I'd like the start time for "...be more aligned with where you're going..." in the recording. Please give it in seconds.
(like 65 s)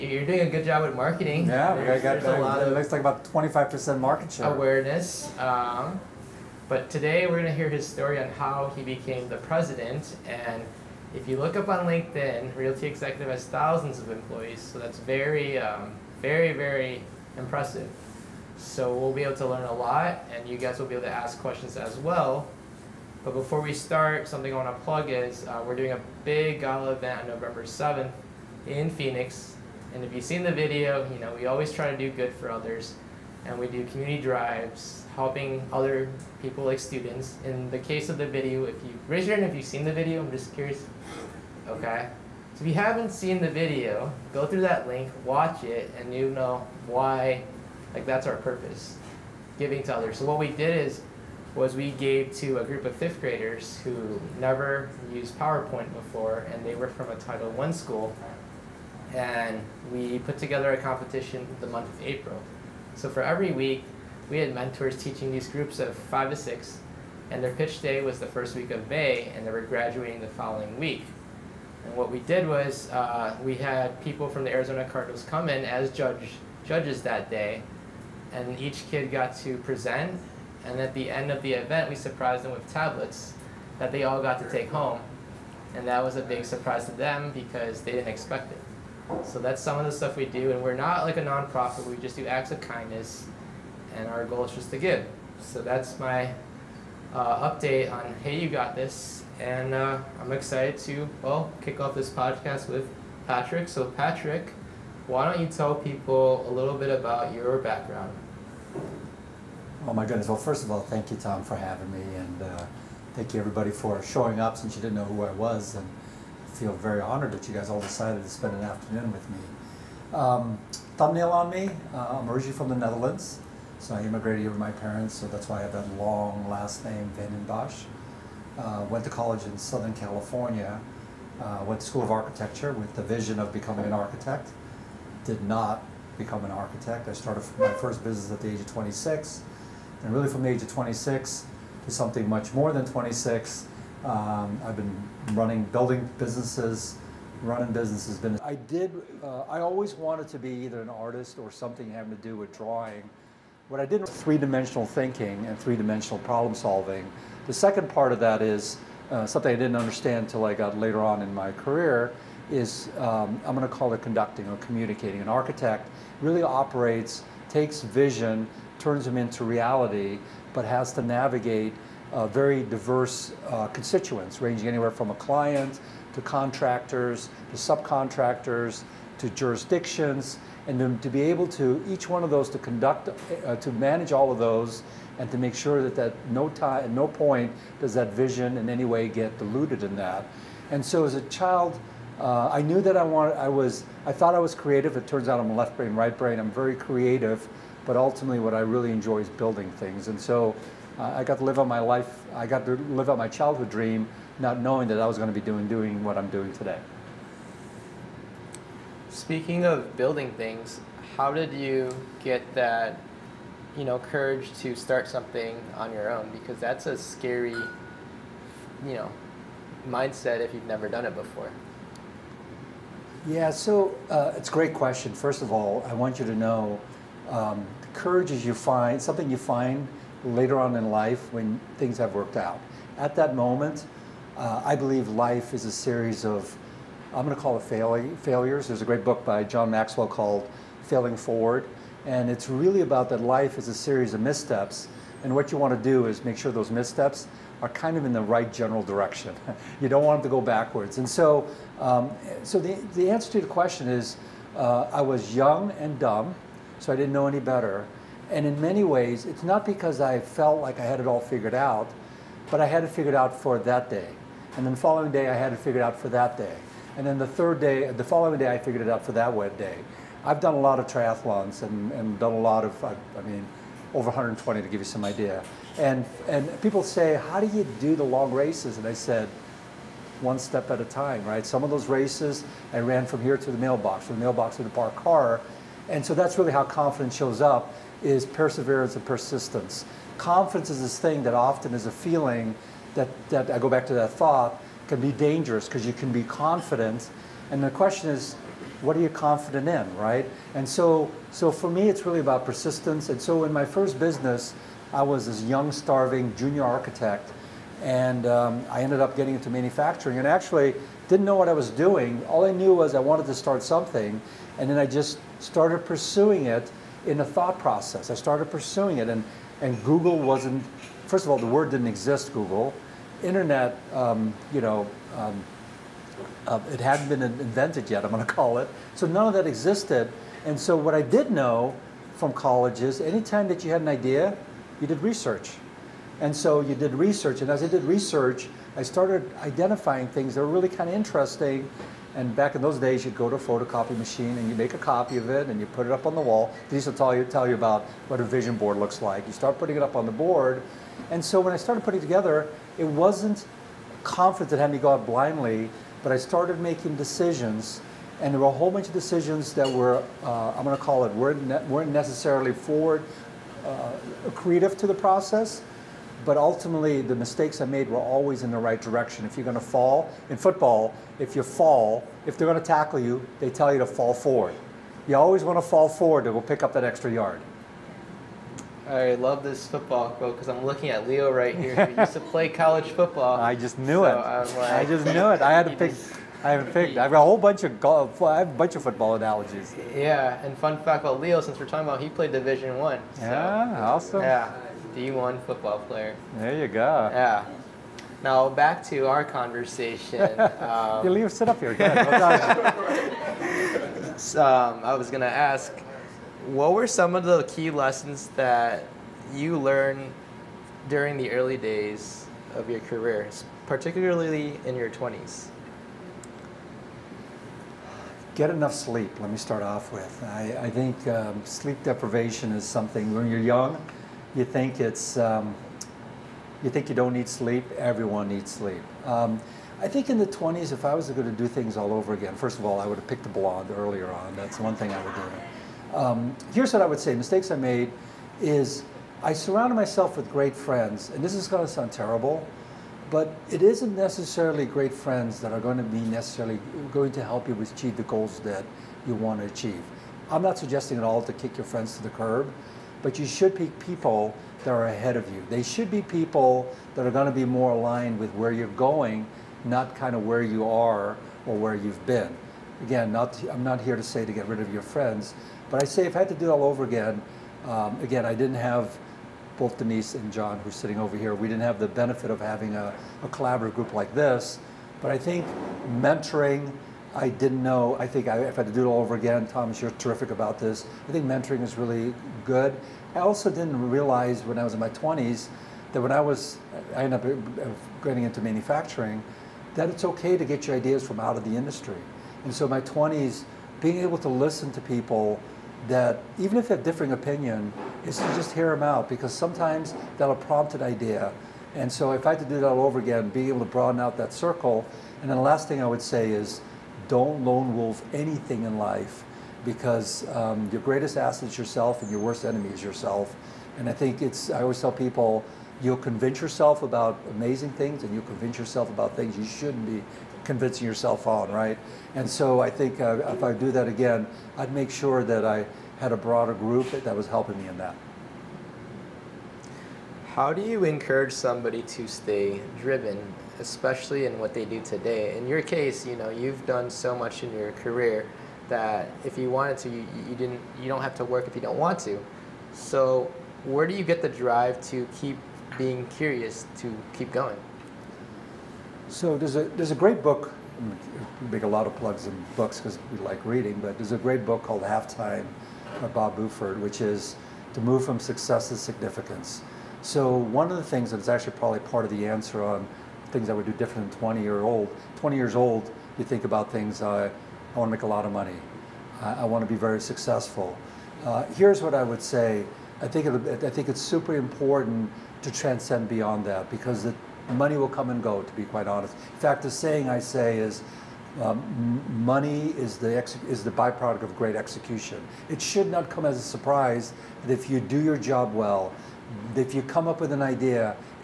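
457 s.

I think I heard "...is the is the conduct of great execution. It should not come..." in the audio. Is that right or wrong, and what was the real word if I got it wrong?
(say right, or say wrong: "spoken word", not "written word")
wrong: "byproduct", not "conduct".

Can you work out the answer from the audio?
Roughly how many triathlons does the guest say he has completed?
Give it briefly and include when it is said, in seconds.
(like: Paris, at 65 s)
Over 120, at 273 s.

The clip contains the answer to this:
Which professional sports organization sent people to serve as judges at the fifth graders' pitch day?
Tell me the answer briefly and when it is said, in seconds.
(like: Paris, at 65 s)
Arizona Cardinals, at 74 s.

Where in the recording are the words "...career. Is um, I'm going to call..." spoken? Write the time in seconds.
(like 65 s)
161 s.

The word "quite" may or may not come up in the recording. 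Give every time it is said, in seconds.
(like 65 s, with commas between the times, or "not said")
578 s.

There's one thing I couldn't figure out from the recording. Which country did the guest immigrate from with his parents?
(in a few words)
The Netherlands.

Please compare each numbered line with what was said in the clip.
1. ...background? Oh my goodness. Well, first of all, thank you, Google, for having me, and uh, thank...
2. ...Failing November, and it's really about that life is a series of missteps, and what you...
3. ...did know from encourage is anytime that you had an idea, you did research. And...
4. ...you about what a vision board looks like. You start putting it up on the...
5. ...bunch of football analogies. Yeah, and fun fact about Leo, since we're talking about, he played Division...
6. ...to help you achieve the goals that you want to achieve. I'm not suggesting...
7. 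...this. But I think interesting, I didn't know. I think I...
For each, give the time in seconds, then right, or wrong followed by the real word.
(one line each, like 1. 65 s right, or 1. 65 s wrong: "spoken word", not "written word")
1. 107 s wrong: "Tom", not "Google"
2. 240 s wrong: "Forward", not "November"
3. 331 s wrong: "college", not "encourage"
4. 347 s right
5. 388 s right
6. 447 s right
7. 474 s wrong: "mentoring", not "interesting".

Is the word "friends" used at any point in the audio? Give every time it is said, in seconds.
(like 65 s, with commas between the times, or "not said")
440 s, 444 s, 451 s, 464 s.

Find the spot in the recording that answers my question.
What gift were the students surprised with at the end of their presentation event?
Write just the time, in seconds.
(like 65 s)
82 s.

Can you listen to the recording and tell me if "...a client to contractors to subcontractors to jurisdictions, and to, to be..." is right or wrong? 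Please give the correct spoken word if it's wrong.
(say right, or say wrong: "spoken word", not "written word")
right.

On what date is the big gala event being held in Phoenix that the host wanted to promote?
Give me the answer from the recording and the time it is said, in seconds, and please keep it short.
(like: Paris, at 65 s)
November 7th, at 27 s.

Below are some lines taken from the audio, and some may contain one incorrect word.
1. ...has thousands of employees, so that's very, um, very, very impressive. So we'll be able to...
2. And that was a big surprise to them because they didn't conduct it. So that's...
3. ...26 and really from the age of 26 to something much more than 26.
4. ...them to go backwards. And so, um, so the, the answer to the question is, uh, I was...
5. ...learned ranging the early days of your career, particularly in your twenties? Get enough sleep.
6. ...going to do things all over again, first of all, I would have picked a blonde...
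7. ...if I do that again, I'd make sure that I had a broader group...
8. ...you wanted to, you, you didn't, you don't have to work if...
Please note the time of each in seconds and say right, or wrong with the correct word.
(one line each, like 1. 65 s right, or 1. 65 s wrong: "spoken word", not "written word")
1. 13 s right
2. 85 s wrong: "expect", not "conduct"
3. 138 s right
4. 250 s right
5. 409 s wrong: "during", not "ranging"
6. 431 s right
7. 523 s right
8. 539 s right.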